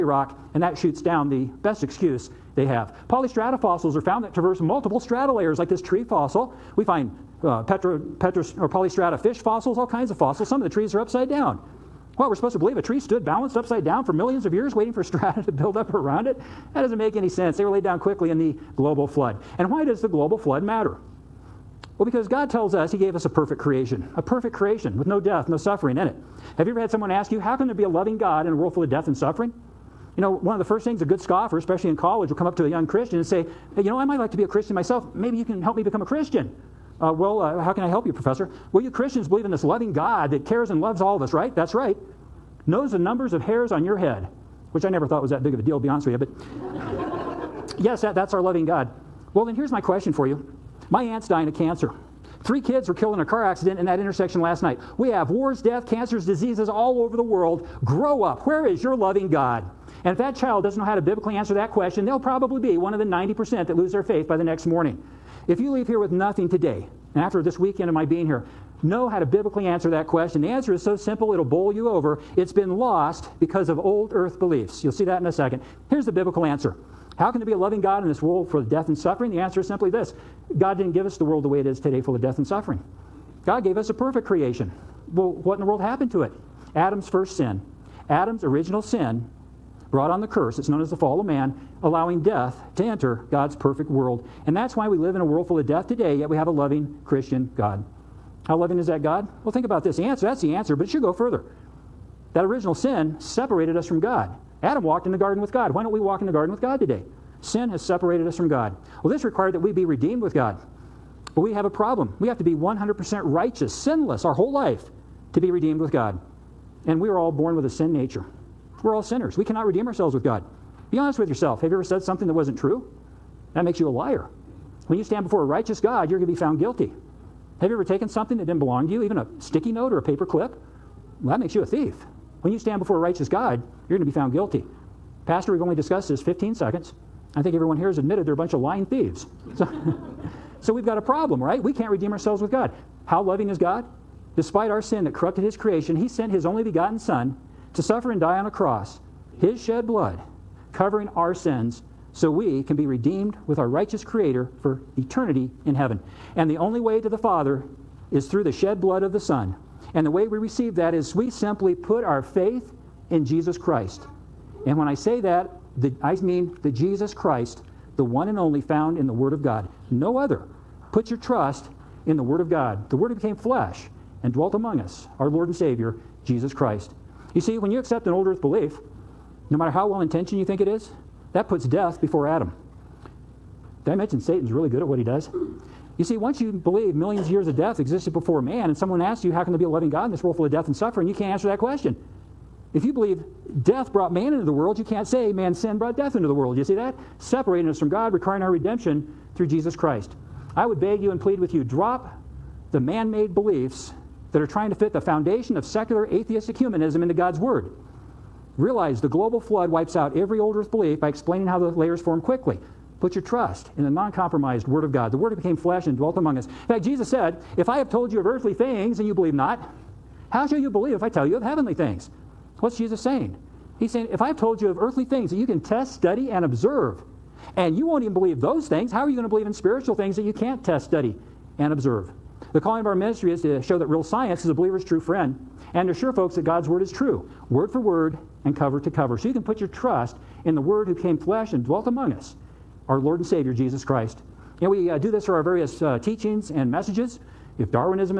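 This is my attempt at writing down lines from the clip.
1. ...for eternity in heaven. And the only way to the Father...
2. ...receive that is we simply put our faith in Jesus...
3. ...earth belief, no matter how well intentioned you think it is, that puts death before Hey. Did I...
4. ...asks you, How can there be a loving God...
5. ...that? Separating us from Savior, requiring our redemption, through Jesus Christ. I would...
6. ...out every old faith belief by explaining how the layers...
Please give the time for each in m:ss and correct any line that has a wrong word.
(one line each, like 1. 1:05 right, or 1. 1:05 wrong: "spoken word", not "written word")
1. 2:34 right
2. 2:40 right
3. 2:58 wrong: "Adam", not "Hey"
4. 3:09 right
5. 3:16 wrong: "God", not "Savior"
6. 3:29 wrong: "earth", not "faith".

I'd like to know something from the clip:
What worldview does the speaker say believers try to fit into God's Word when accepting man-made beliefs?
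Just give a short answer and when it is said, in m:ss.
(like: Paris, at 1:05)
secular atheistic humanism, at 3:25.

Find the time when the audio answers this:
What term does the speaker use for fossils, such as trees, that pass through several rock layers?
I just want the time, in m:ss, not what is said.
0:03.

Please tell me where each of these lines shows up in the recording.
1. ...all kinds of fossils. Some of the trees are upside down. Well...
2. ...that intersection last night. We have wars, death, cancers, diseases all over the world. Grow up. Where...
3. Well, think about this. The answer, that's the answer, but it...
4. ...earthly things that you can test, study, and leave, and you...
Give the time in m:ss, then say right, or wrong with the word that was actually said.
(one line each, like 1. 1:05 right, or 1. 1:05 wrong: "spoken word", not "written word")
1. 0:09 right
2. 0:53 right
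3. 1:39 right
4. 3:44 wrong: "observe", not "leave".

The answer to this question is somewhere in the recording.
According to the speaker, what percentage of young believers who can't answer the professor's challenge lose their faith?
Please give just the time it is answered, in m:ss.
1:03.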